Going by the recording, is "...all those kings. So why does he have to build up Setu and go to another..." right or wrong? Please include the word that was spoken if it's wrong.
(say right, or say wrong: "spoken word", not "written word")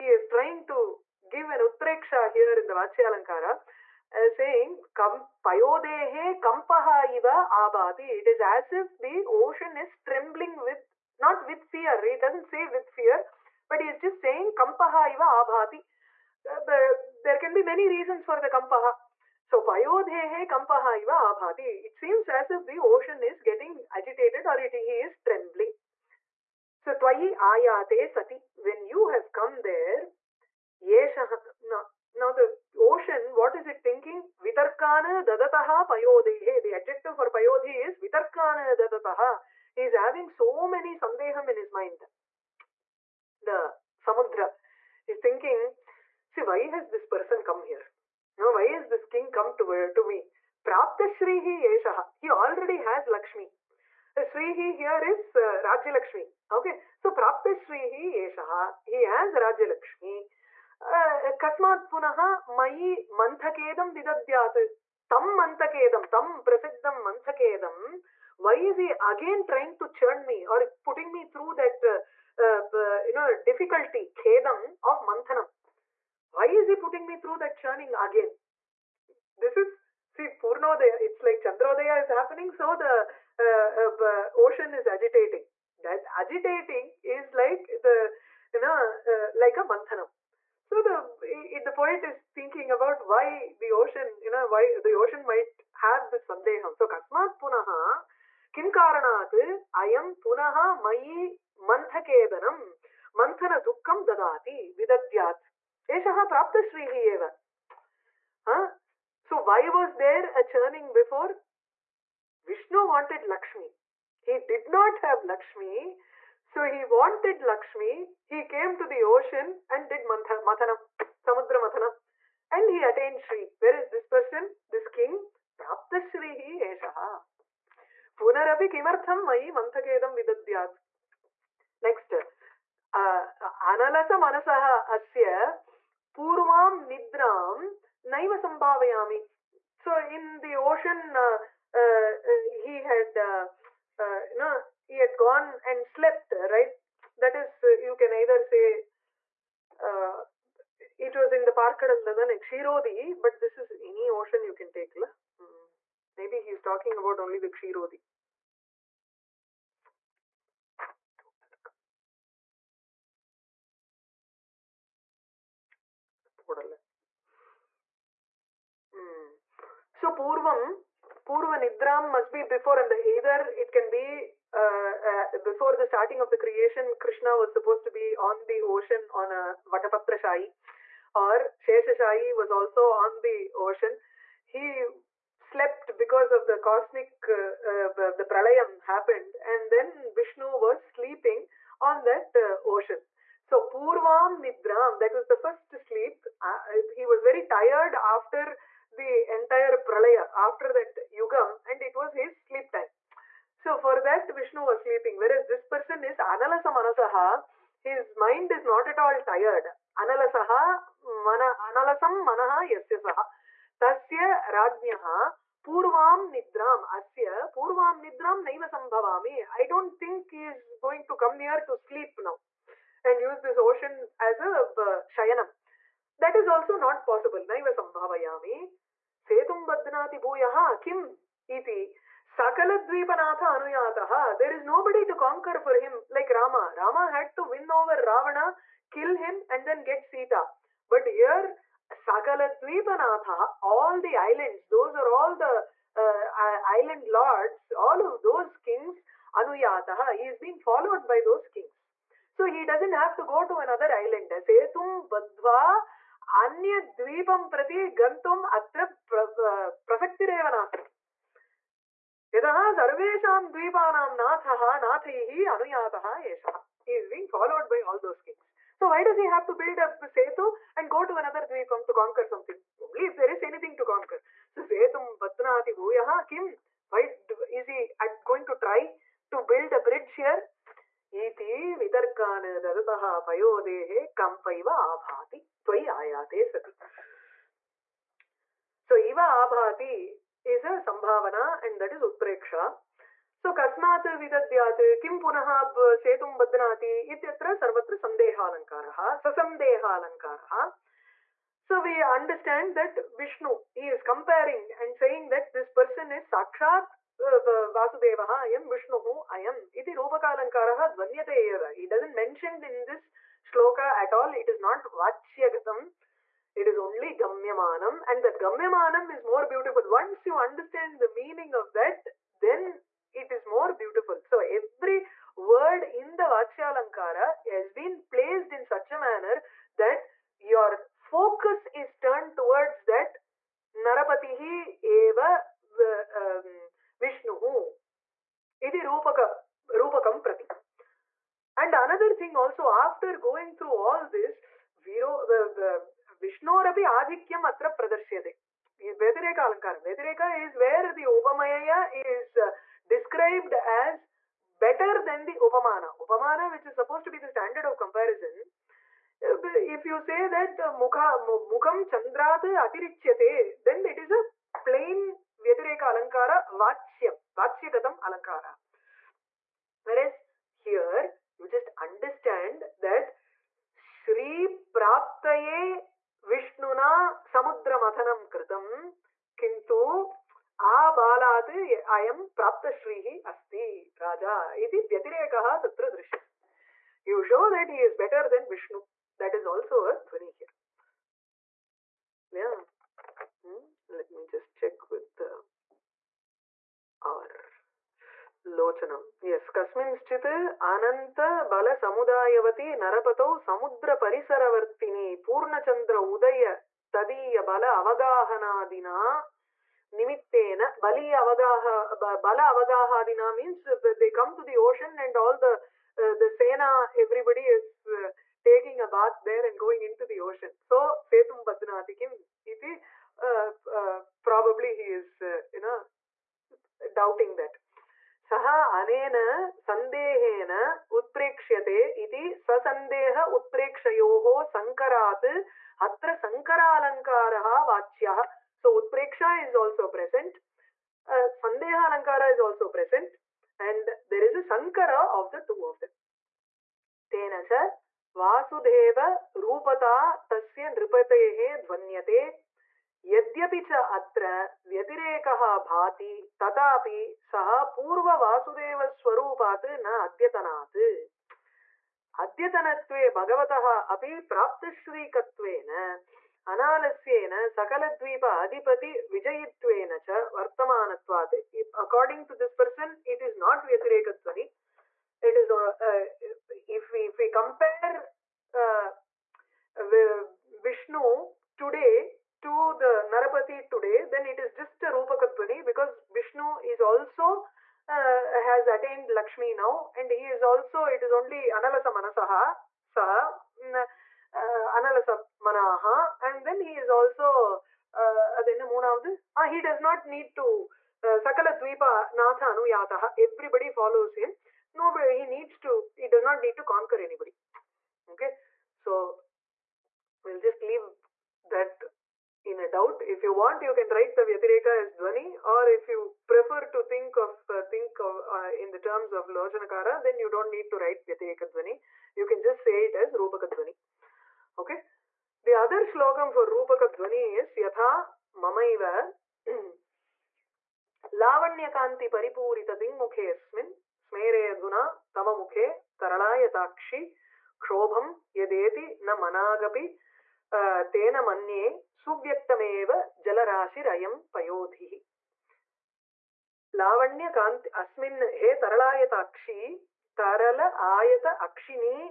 right.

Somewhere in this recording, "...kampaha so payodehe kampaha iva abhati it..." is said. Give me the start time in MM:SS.
00:18.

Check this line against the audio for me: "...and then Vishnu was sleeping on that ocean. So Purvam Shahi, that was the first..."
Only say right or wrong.
wrong.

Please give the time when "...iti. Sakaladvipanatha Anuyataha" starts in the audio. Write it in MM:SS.
03:51.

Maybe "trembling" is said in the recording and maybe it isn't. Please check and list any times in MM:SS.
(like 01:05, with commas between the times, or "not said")
00:10, 00:25.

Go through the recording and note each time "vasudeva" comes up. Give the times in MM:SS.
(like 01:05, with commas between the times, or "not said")
05:07, 07:28.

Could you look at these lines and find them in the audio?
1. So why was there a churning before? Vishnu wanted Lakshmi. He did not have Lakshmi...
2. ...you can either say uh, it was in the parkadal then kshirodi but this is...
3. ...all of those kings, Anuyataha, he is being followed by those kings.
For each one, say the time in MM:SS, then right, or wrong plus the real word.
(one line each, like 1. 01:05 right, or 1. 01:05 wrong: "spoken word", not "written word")
1. 01:49 right
2. 02:27 right
3. 04:07 right.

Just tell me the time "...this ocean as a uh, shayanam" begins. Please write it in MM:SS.
03:43.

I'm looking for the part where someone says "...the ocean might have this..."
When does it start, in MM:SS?
01:34.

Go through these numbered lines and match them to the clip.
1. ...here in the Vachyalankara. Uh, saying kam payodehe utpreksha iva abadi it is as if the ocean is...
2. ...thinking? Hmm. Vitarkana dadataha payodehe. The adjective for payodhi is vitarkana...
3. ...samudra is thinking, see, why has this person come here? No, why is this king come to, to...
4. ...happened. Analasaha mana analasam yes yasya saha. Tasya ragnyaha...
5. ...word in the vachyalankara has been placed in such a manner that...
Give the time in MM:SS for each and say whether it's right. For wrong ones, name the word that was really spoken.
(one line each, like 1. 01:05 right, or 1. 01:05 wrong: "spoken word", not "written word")
1. 00:02 wrong: "kampaha", not "utpreksha"
2. 00:33 right
3. 00:44 right
4. 03:29 wrong: "tired", not "happened"
5. 05:25 right.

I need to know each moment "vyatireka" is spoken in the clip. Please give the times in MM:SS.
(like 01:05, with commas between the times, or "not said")
06:05, 08:34, 08:41.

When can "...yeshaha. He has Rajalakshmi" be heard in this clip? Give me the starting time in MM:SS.
00:58.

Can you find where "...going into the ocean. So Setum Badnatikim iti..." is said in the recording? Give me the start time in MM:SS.
06:59.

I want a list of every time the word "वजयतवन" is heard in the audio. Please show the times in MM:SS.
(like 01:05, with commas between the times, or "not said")
07:49.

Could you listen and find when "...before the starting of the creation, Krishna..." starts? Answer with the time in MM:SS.
02:55.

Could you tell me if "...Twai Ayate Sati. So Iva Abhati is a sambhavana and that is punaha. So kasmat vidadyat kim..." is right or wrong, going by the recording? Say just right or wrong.
wrong.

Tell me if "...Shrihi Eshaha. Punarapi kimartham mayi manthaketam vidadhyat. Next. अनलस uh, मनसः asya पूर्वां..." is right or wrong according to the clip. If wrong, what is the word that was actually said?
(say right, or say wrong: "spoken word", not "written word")
right.